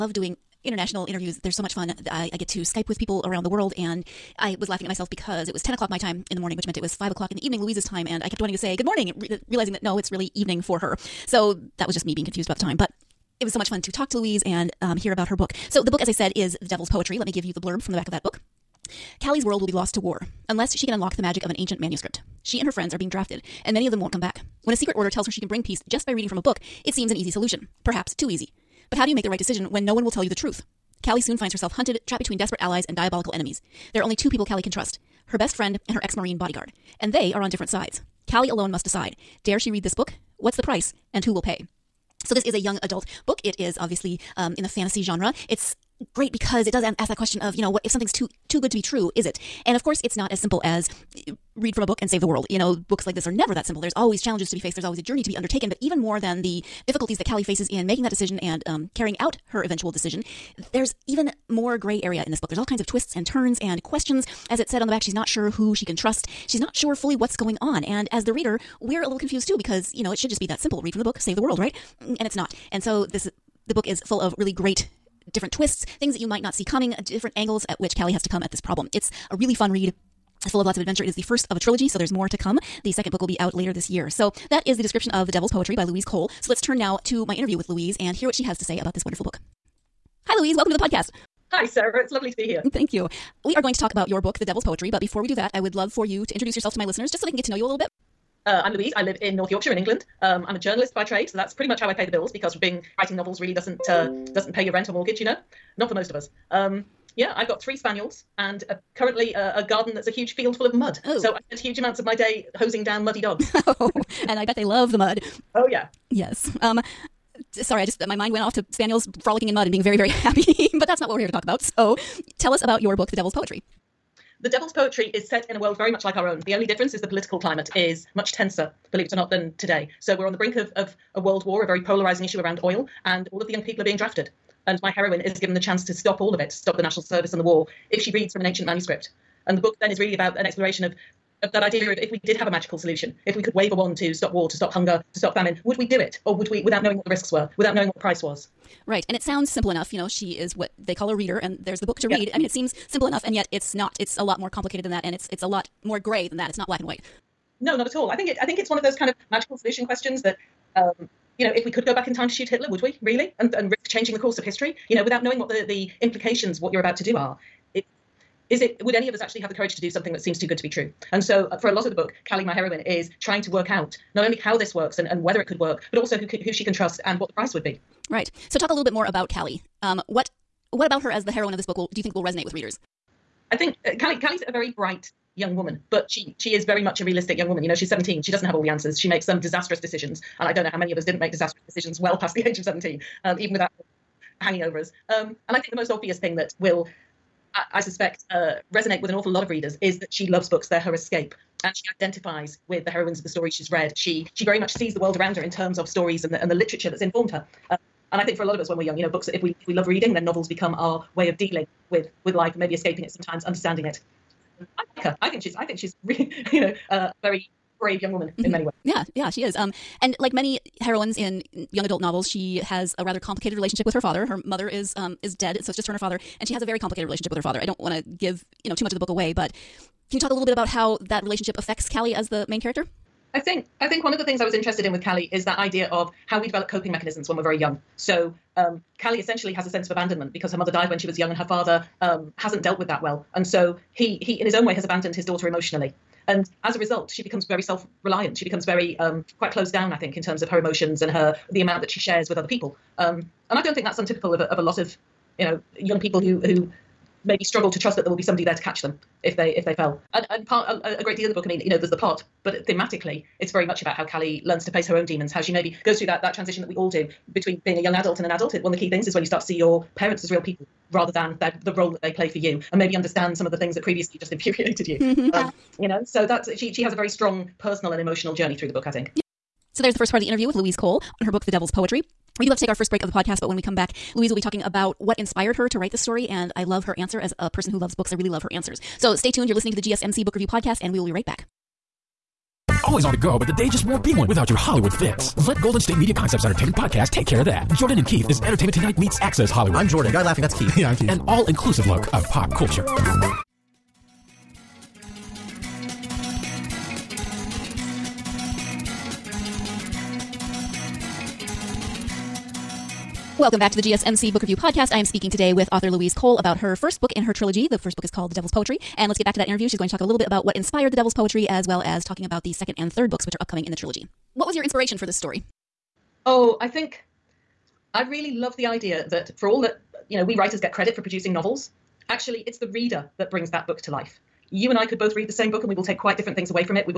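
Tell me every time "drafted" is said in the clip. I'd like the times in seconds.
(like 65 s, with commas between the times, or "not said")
23 s, 133 s.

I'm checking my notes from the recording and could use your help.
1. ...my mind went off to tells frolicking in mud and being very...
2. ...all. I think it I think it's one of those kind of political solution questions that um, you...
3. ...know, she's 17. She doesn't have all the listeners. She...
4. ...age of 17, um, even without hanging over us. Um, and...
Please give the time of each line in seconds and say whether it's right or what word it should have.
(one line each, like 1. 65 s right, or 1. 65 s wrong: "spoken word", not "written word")
1. 118 s wrong: "spaniels", not "tells"
2. 157 s wrong: "magical", not "political"
3. 187 s wrong: "answers", not "listeners"
4. 192 s right.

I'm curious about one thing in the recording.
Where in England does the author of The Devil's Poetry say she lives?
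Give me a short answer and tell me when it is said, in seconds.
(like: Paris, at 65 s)
North Yorkshire, at 99 s.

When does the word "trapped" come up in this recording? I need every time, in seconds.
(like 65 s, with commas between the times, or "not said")
32 s.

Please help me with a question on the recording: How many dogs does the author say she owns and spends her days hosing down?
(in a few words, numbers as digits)
3.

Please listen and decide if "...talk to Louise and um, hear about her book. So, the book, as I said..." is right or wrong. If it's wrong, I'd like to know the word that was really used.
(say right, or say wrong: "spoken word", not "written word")
right.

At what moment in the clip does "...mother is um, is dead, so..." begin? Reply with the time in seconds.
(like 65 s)
224 s.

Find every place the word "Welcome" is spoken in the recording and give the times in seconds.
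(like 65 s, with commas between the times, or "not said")
90 s, 313 s.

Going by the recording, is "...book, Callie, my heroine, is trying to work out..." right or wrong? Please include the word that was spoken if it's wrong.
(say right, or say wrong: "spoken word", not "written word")
right.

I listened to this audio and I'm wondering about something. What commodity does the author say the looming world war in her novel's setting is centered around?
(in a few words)
Oil.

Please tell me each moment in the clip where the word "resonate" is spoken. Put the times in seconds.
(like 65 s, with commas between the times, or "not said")
182 s, 198 s.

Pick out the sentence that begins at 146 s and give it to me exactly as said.
Or would we, without knowing what the risks were, without knowing what the price was?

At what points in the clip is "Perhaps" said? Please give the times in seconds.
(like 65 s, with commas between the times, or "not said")
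27 s.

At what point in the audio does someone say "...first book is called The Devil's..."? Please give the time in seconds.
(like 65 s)
317 s.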